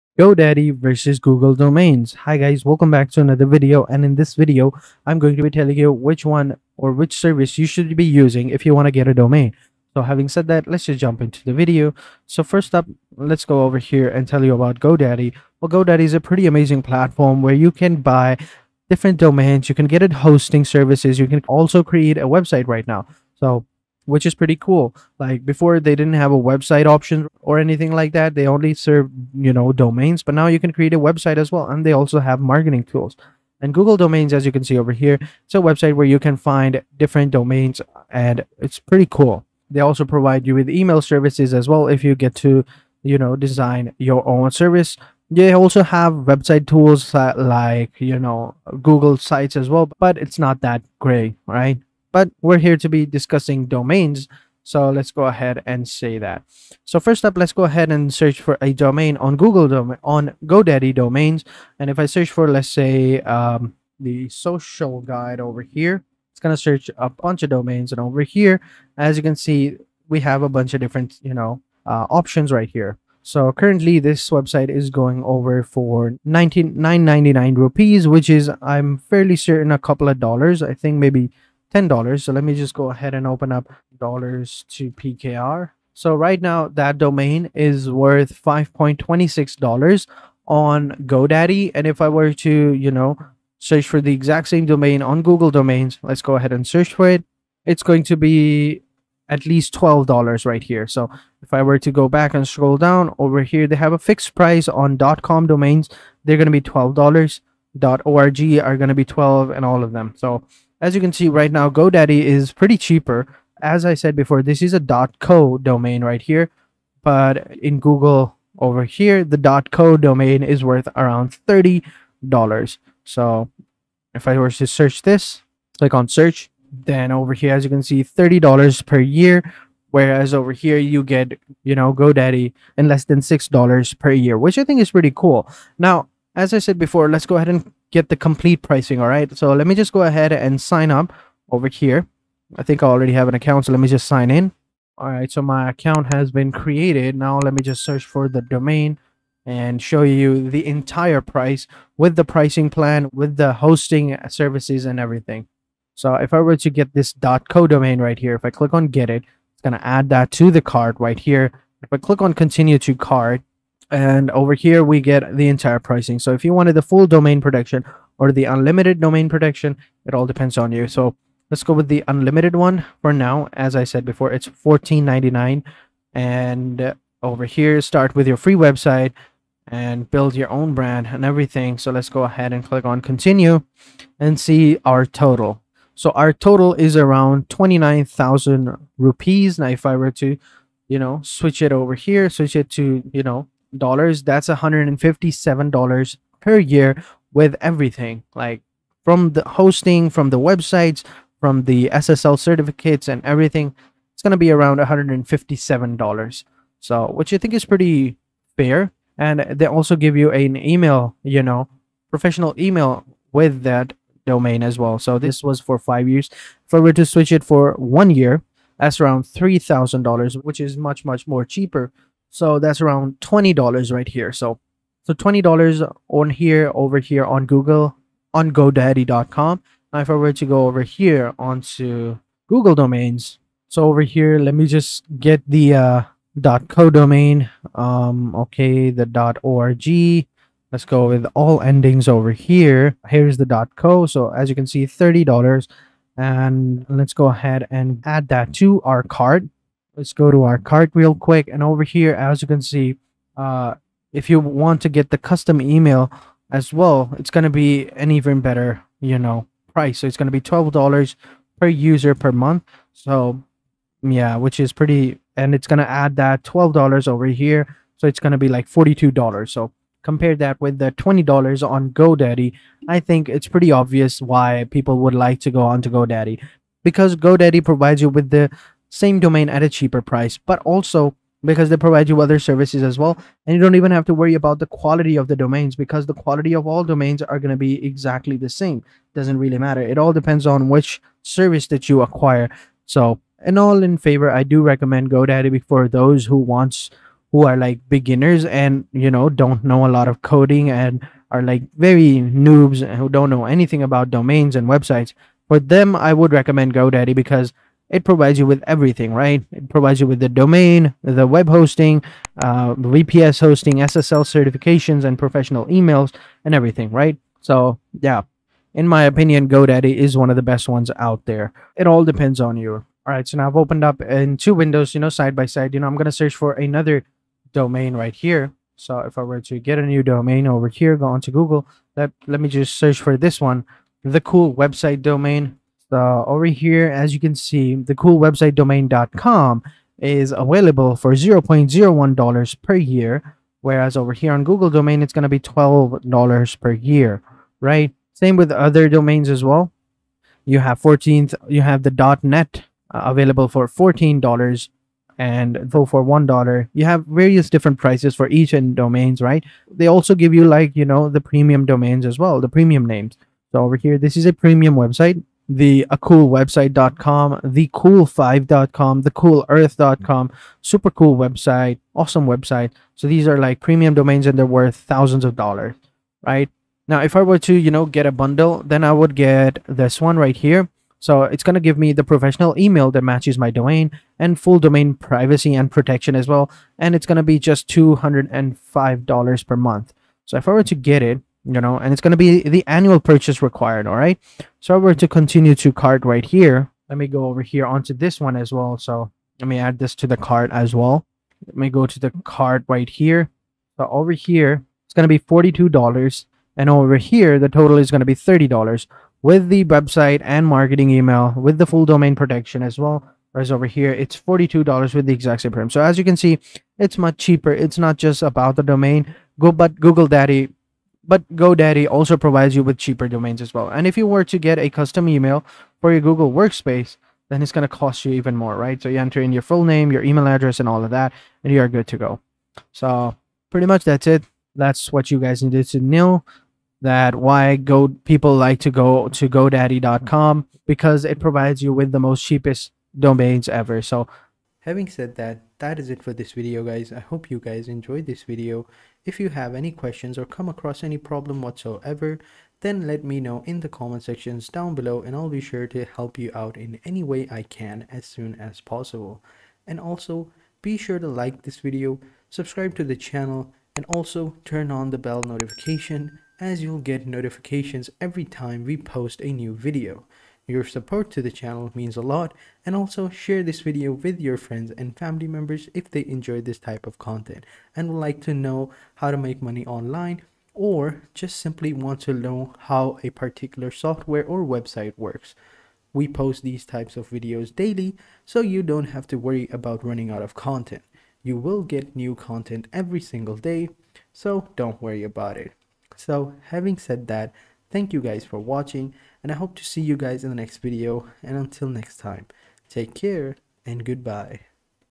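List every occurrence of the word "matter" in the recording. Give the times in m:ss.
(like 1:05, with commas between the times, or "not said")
4:49.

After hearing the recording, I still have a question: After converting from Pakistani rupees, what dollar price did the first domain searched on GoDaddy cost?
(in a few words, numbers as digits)
$5.26.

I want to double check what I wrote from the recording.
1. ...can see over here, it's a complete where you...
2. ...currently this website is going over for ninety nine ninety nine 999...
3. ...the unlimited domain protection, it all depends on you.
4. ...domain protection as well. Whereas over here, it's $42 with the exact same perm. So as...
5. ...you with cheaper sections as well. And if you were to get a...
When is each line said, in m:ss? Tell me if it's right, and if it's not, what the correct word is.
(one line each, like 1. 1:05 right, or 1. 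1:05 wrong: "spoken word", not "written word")
1. 0:34 wrong: "website", not "complete"
2. 1:13 right
3. 2:48 right
4. 6:51 right
5. 7:02 wrong: "domains", not "sections".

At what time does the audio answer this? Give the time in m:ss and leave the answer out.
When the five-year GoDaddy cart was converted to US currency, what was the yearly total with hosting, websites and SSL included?
3:14.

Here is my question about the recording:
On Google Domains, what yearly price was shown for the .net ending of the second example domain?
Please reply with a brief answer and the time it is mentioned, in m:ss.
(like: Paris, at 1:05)
$14, at 5:53.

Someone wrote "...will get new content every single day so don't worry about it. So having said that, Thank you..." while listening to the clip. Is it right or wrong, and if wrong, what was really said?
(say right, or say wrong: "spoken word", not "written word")
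right.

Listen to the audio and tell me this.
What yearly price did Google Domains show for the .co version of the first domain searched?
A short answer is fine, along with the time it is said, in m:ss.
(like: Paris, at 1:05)
$30, at 2:08.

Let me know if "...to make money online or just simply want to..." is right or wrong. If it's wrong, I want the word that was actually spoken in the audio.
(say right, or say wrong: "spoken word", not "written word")
right.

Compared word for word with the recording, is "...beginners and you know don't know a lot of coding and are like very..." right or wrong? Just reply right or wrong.
right.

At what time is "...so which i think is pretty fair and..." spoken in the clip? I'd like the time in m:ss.
3:26.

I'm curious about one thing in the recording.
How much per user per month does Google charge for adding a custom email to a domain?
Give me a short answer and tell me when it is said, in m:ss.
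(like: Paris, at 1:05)
$12, at 4:20.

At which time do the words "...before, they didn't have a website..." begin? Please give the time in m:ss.
0:25.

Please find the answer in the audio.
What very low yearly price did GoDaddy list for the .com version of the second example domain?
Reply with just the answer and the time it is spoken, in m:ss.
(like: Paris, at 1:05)
$0.01, at 5:41.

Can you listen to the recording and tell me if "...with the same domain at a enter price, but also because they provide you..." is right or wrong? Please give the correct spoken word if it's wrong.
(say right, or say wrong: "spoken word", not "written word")
wrong: "cheaper", not "enter".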